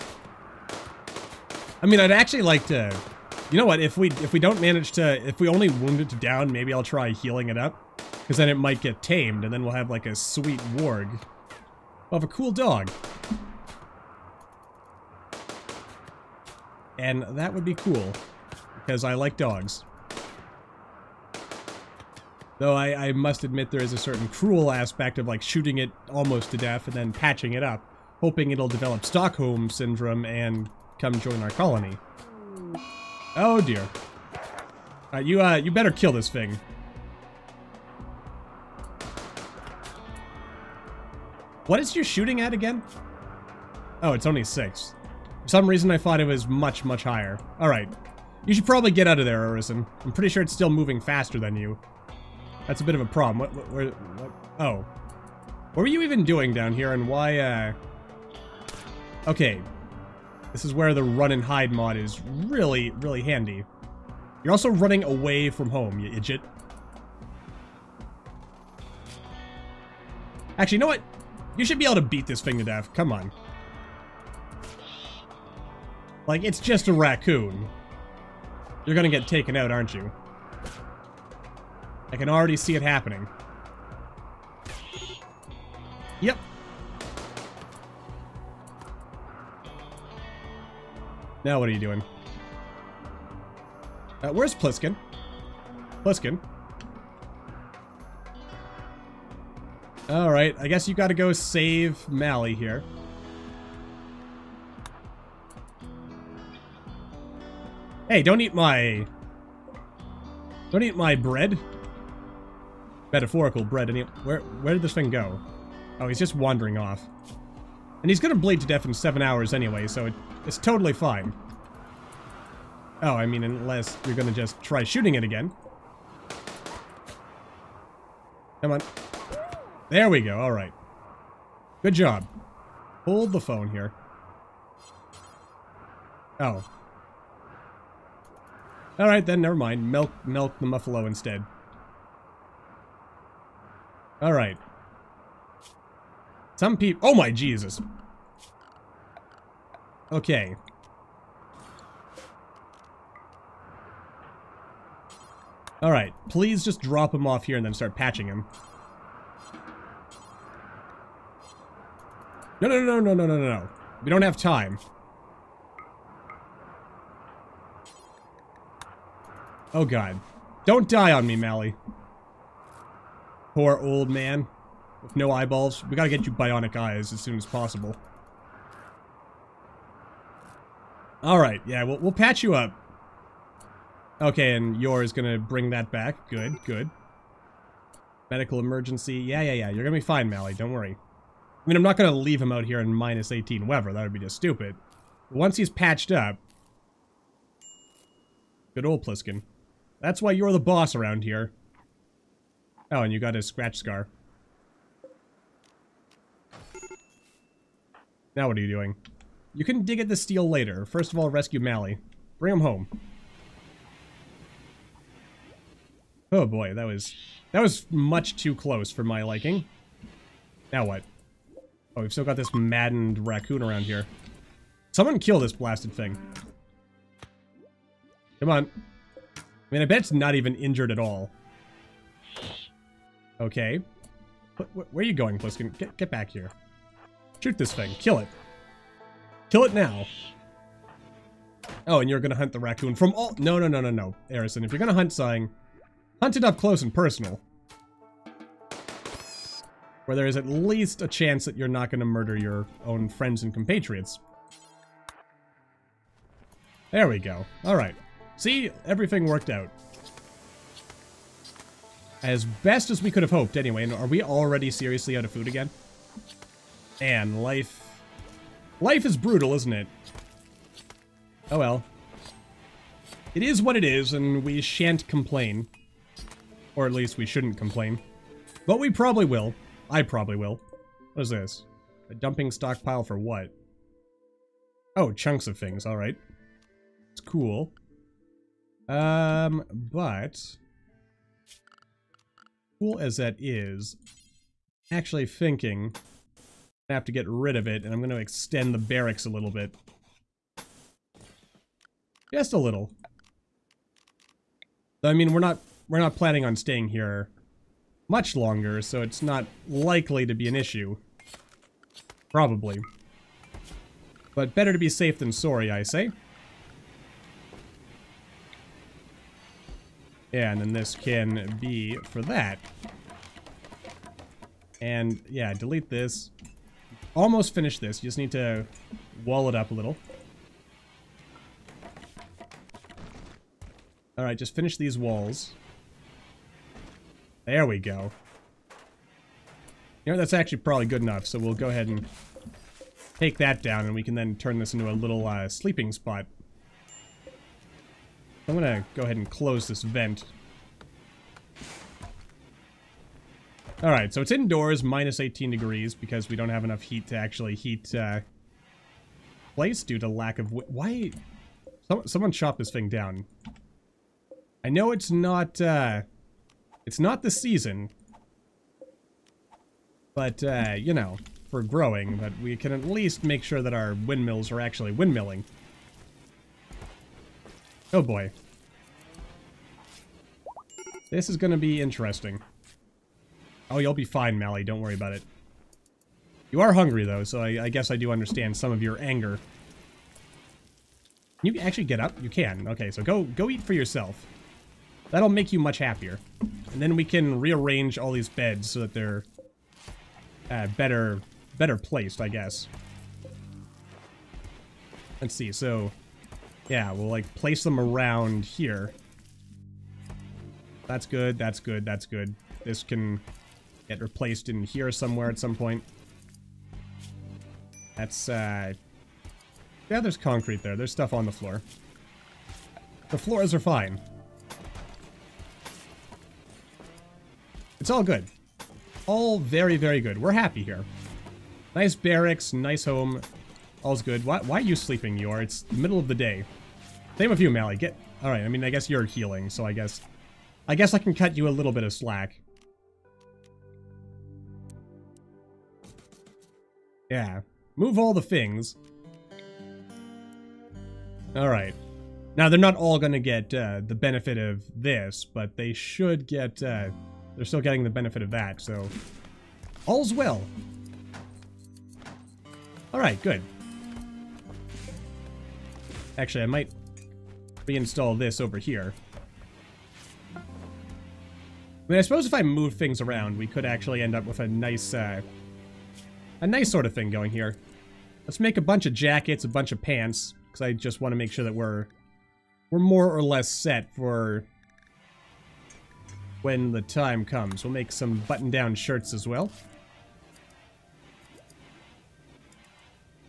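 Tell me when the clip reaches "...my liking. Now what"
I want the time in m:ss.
3:39.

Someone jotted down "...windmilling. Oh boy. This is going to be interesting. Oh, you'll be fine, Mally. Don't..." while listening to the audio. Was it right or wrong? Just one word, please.
right.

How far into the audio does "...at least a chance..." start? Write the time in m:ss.
4:10.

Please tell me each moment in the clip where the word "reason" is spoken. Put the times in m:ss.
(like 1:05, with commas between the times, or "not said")
0:45.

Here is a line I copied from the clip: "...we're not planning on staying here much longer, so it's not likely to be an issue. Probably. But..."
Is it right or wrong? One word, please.
right.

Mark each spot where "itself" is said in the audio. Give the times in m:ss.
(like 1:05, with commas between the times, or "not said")
not said.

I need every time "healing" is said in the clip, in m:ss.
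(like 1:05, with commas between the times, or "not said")
0:07, 7:19.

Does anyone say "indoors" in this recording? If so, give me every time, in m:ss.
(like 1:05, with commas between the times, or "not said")
5:54.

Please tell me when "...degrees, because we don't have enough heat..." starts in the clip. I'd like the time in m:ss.
5:55.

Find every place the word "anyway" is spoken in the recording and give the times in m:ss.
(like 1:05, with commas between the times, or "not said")
1:59, 4:23.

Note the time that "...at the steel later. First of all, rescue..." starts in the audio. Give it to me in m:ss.
3:29.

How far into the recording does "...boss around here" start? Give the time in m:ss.
3:20.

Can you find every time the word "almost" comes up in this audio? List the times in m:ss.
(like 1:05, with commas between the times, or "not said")
0:26, 5:27.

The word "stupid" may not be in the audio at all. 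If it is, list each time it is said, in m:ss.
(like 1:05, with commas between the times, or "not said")
3:14.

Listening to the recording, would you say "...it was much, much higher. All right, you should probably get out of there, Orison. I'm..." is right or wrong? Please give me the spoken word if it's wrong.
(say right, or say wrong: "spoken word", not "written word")
right.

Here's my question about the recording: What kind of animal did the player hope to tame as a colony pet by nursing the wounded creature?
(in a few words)
warg.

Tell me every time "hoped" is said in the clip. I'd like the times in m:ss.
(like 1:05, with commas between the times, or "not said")
4:23.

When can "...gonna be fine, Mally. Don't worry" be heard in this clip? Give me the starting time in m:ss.
3:09.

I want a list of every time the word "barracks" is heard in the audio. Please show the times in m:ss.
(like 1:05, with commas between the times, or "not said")
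4:58, 7:11.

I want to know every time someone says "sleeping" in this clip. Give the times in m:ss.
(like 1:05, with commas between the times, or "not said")
5:45, 7:14.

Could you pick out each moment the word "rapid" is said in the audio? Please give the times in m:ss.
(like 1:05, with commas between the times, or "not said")
not said.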